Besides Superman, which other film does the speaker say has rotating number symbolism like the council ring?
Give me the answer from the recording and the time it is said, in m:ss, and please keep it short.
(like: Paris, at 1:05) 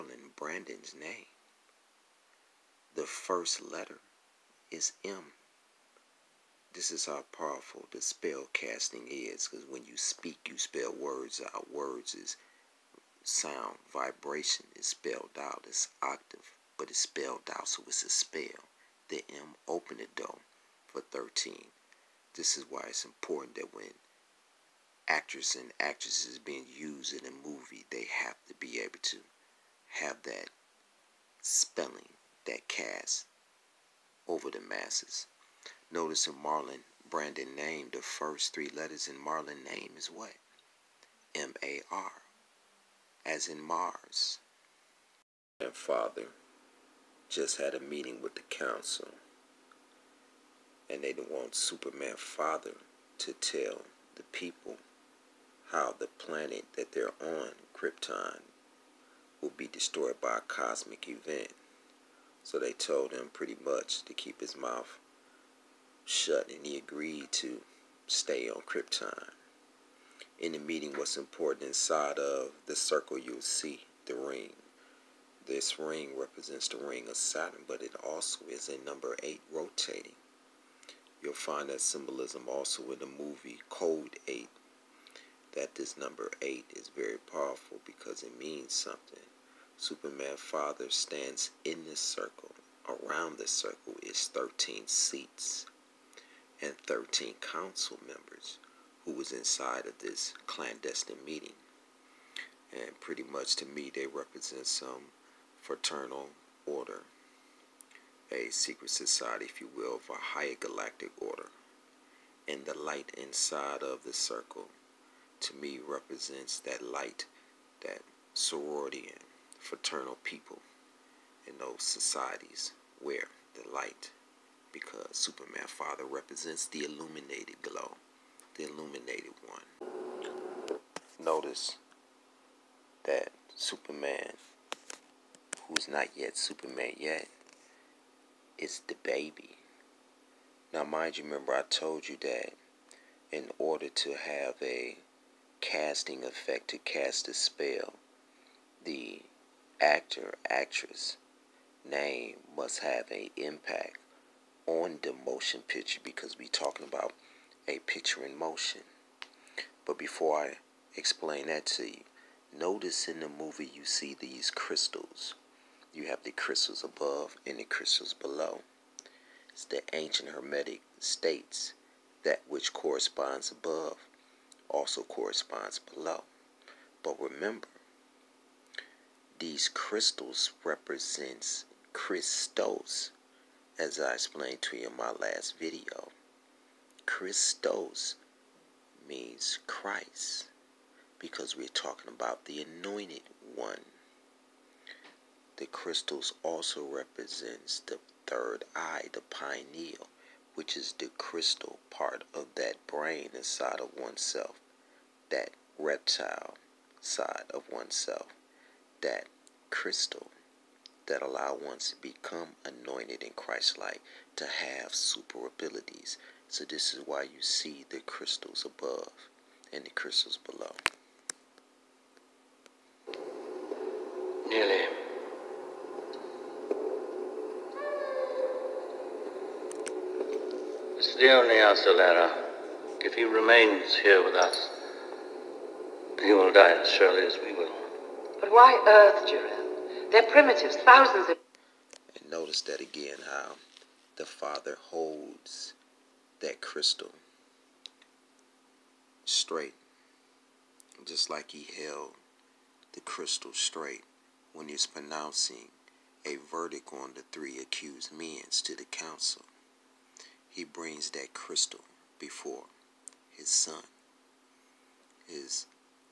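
Code 8, at 1:23.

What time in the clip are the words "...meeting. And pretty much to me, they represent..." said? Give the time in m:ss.
1:41.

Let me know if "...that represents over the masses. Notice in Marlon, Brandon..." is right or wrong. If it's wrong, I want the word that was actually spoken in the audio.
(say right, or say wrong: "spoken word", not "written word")
wrong: "casts", not "represents".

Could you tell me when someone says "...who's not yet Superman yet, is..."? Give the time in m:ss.
2:15.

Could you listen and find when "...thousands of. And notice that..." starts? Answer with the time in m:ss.
4:00.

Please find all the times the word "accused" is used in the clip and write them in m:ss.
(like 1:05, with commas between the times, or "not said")
4:17.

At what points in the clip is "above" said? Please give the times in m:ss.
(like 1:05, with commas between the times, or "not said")
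2:46, 2:53, 3:38.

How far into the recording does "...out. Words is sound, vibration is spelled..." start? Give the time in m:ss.
0:11.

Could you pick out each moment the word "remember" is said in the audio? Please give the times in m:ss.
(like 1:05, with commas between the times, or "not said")
2:21, 2:57.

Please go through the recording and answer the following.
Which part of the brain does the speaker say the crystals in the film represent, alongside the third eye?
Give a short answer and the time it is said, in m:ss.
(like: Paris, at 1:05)
the pineal, at 3:19.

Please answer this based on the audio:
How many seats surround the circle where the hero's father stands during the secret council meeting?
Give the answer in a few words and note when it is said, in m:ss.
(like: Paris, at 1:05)
13, at 1:34.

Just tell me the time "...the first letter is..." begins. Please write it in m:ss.
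0:02.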